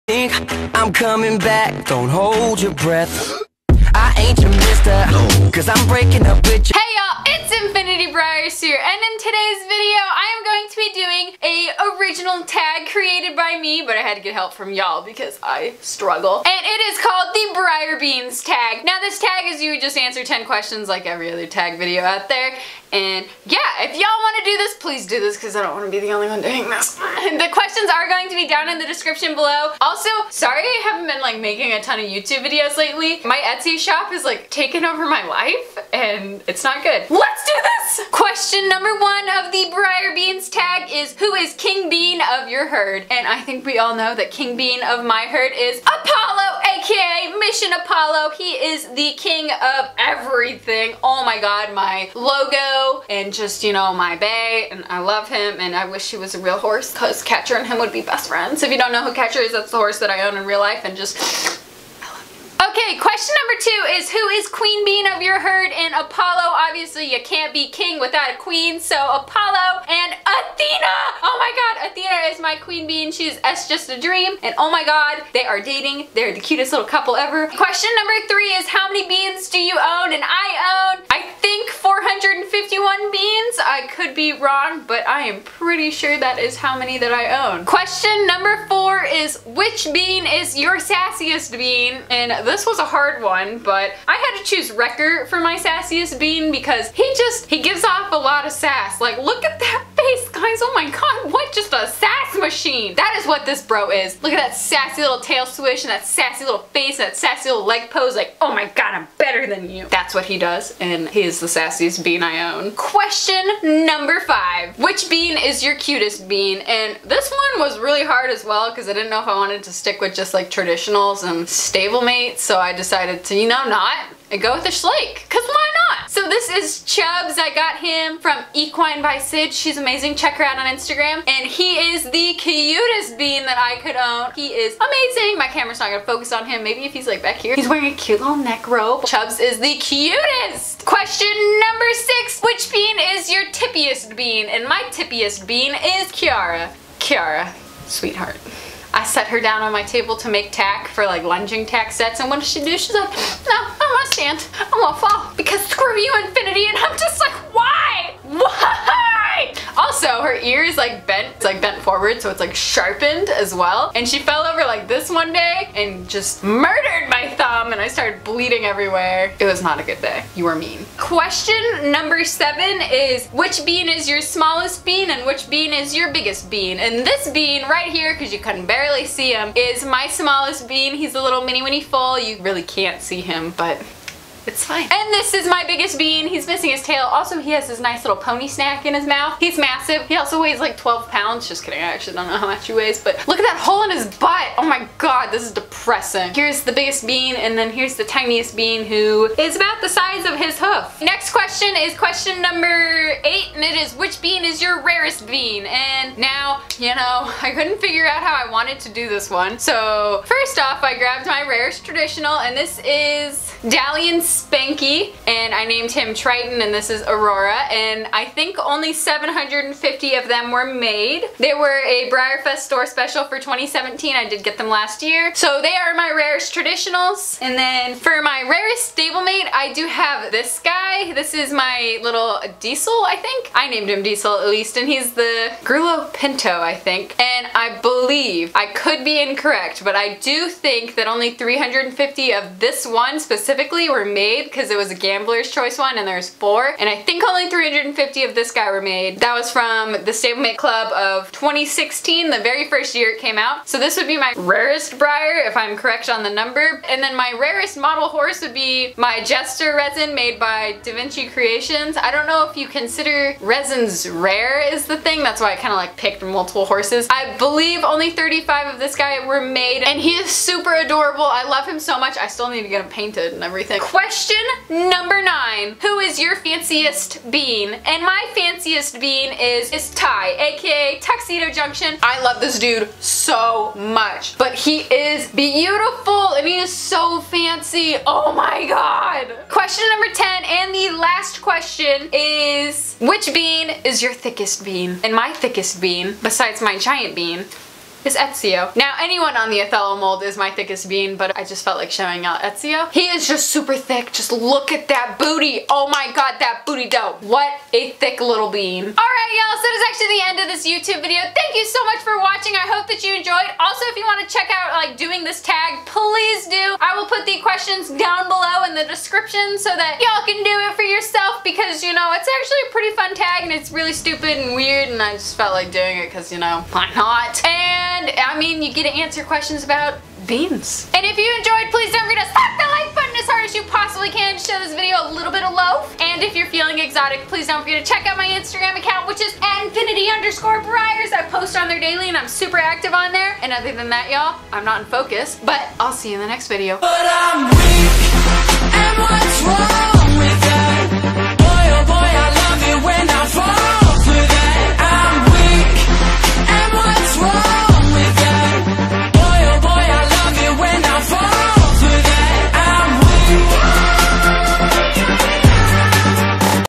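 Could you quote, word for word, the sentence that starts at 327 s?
And and I mean, you get to answer questions about beans.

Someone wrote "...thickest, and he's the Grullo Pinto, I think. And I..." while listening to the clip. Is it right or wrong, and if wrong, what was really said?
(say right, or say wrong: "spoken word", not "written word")
wrong: "least", not "thickest".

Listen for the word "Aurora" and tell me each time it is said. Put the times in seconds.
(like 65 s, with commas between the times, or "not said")
217 s.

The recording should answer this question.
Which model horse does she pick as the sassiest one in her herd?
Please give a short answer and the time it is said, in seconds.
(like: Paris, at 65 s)
Wrecker, at 94 s.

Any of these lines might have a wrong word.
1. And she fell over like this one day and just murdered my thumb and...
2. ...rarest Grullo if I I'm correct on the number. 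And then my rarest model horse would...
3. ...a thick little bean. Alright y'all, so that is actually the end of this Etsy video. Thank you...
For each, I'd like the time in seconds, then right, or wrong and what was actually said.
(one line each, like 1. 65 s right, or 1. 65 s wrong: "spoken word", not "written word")
1. 163 s right
2. 254 s wrong: "Breyer", not "Grullo"
3. 307 s wrong: "YouTube", not "Etsy".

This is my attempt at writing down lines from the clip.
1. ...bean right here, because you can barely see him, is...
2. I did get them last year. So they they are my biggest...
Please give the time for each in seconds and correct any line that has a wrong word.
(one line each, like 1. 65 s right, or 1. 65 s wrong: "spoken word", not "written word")
1. 177 s right
2. 224 s wrong: "rarest", not "biggest".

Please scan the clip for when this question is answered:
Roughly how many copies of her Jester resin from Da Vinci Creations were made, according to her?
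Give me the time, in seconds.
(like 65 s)
268 s.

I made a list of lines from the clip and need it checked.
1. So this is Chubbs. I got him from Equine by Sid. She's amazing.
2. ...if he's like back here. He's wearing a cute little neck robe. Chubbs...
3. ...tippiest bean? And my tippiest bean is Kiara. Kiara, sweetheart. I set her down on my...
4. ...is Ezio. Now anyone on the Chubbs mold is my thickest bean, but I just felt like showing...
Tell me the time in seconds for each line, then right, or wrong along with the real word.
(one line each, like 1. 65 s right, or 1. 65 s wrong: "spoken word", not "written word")
1. 126 s right
2. 136 s right
3. 143 s right
4. 298 s wrong: "Othello", not "Chubbs".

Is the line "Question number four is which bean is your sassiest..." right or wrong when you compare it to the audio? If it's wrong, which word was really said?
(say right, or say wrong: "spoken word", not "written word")
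right.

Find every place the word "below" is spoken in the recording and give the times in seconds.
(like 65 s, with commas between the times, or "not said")
29 s, 318 s.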